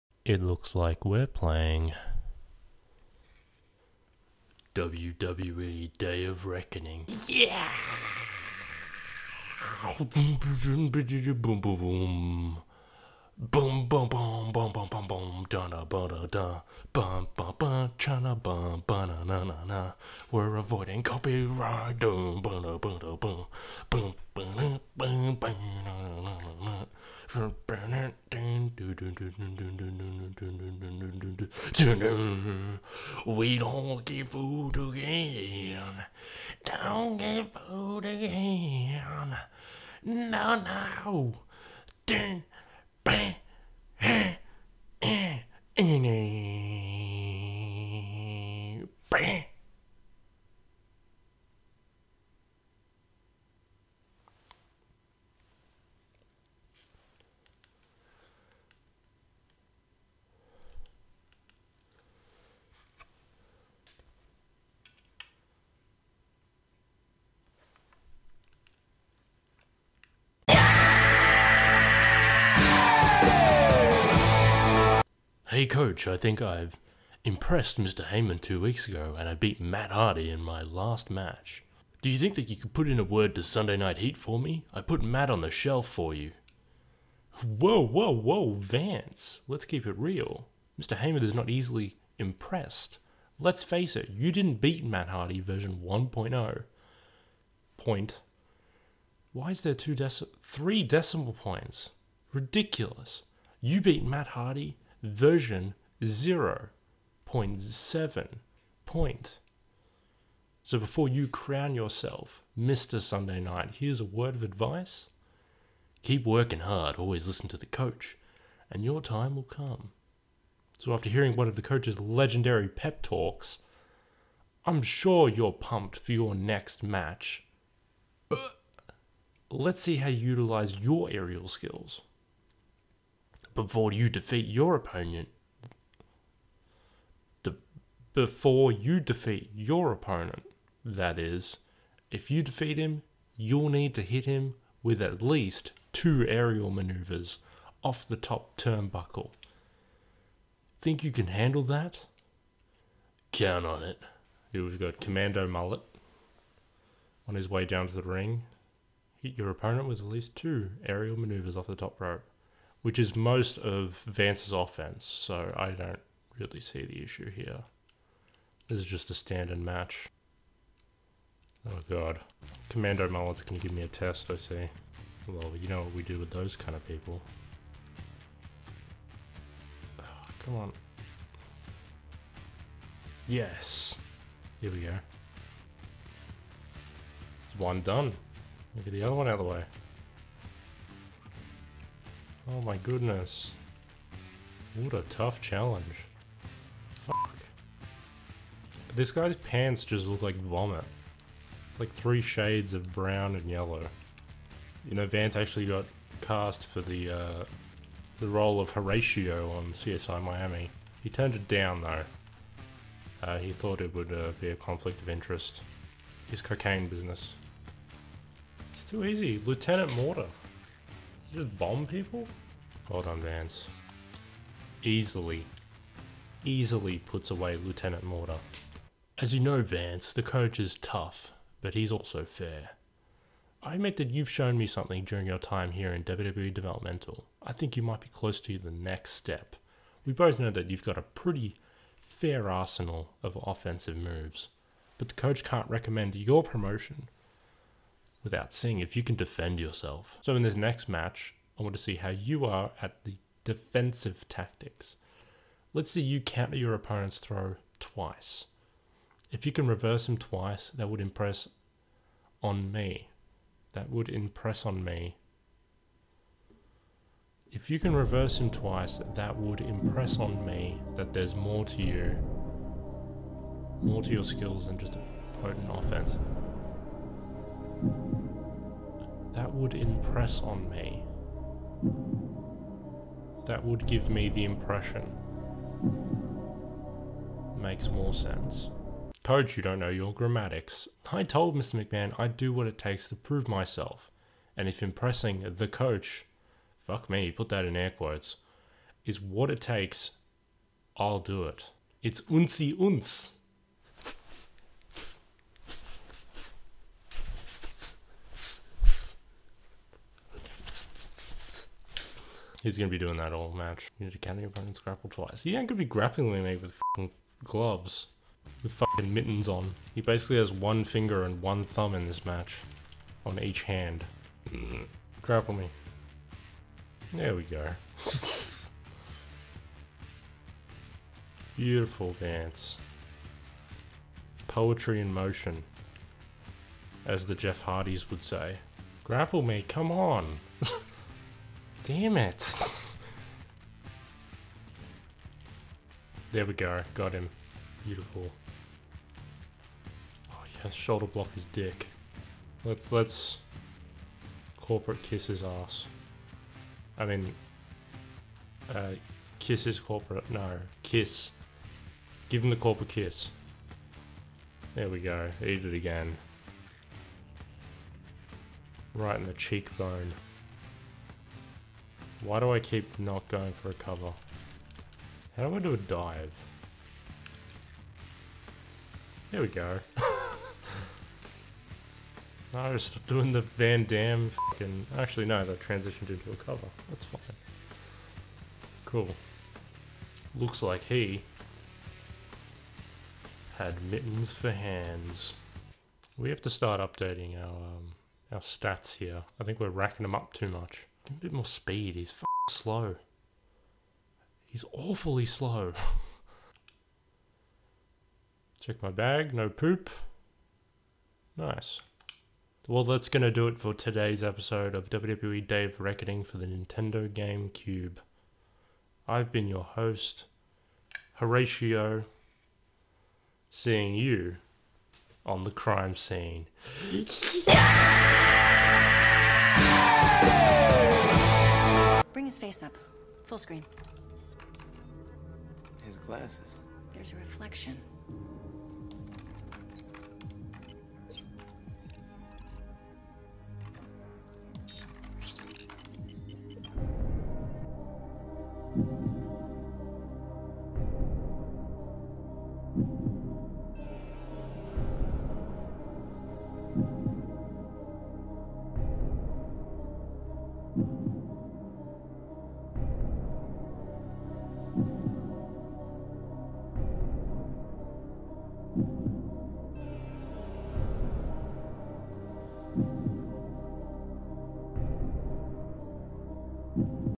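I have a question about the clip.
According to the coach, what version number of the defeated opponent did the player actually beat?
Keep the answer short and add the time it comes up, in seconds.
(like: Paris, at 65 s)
0.7, at 106 s.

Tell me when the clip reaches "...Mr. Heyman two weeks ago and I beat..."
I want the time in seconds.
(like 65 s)
77 s.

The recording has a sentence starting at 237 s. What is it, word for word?
I think you might be close to the next step.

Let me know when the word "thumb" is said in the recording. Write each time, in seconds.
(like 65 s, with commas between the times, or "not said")
321 s.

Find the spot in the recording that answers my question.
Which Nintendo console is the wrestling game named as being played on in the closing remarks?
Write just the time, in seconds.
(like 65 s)
417 s.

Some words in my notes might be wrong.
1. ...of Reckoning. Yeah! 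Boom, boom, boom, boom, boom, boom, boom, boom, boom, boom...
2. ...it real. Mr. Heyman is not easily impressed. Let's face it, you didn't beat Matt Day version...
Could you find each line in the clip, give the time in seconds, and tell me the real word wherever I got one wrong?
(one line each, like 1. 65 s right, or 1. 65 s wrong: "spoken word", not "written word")
1. 6 s right
2. 89 s wrong: "Hardy", not "Day".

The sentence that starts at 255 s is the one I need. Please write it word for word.
Let's see you counter your opponent's throw twice.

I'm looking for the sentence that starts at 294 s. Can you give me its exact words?
And if impressing the coach, fuck me, put that in air quotes, is what it takes, I'll do it.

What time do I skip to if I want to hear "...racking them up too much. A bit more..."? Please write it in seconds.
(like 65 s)
399 s.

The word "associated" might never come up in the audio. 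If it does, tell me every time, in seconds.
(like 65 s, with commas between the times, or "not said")
not said.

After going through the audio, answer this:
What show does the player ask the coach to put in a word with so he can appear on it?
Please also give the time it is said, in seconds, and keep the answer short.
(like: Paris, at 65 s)
Sunday Night Heat, at 83 s.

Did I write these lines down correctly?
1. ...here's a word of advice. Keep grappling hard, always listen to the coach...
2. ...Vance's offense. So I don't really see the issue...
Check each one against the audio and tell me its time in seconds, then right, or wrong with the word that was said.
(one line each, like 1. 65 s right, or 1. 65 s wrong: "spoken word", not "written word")
1. 113 s wrong: "working", not "grappling"
2. 164 s right.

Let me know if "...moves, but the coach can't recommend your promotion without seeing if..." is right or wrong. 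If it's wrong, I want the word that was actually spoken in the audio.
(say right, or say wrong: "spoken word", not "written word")
right.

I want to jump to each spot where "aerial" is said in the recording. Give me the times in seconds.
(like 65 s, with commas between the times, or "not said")
131 s, 146 s, 160 s.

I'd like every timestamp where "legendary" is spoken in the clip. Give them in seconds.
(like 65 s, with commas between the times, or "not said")
121 s.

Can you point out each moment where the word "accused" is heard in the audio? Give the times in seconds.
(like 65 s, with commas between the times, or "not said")
not said.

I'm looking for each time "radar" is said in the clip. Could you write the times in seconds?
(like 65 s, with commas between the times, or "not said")
not said.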